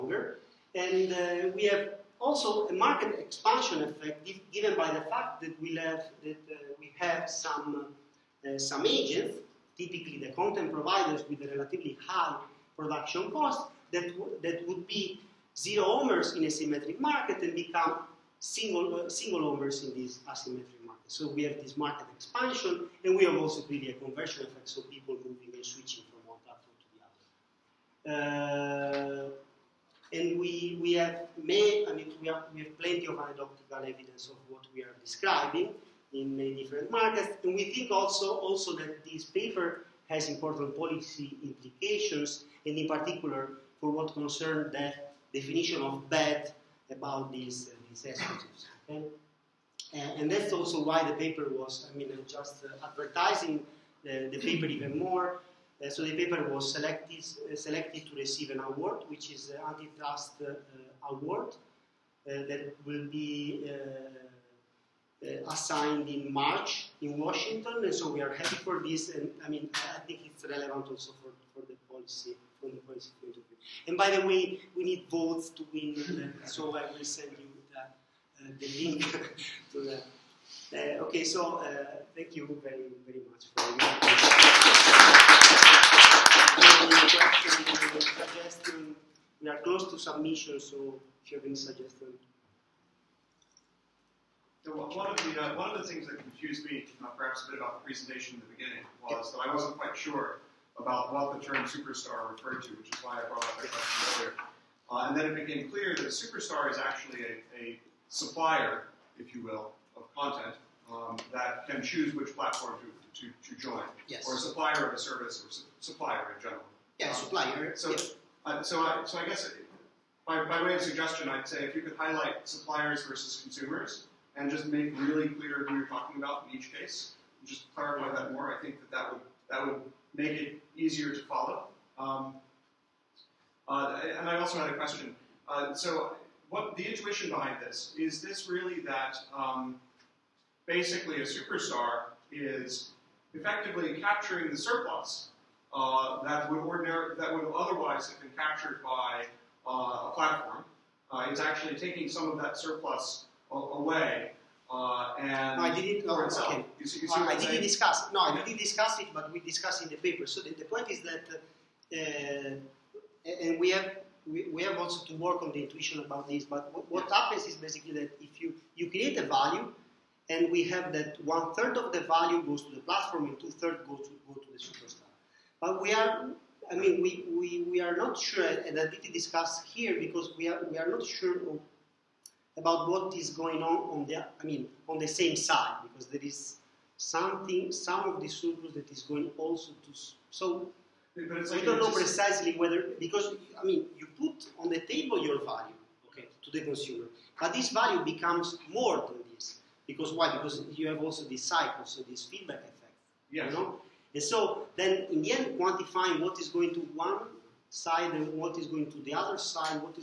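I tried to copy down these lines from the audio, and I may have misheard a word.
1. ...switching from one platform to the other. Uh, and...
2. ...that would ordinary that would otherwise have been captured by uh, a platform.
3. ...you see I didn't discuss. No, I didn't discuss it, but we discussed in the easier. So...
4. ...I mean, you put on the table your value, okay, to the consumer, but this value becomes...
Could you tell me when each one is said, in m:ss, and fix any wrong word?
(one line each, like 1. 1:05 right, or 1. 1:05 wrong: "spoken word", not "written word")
1. 0:25 right
2. 2:26 right
3. 2:37 wrong: "paper", not "easier"
4. 3:13 right.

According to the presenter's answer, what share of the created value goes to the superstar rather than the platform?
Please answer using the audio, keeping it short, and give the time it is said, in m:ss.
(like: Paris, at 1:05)
Two thirds, at 2:53.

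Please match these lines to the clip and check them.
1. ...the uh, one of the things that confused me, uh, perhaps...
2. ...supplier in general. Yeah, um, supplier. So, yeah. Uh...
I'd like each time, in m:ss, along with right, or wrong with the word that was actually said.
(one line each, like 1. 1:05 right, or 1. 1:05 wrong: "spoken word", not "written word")
1. 1:35 right
2. 1:55 right.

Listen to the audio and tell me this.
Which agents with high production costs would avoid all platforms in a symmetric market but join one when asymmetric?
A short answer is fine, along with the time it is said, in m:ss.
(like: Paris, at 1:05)
Content providers, at 0:10.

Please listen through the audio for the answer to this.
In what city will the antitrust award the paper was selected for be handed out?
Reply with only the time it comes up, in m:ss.
1:07.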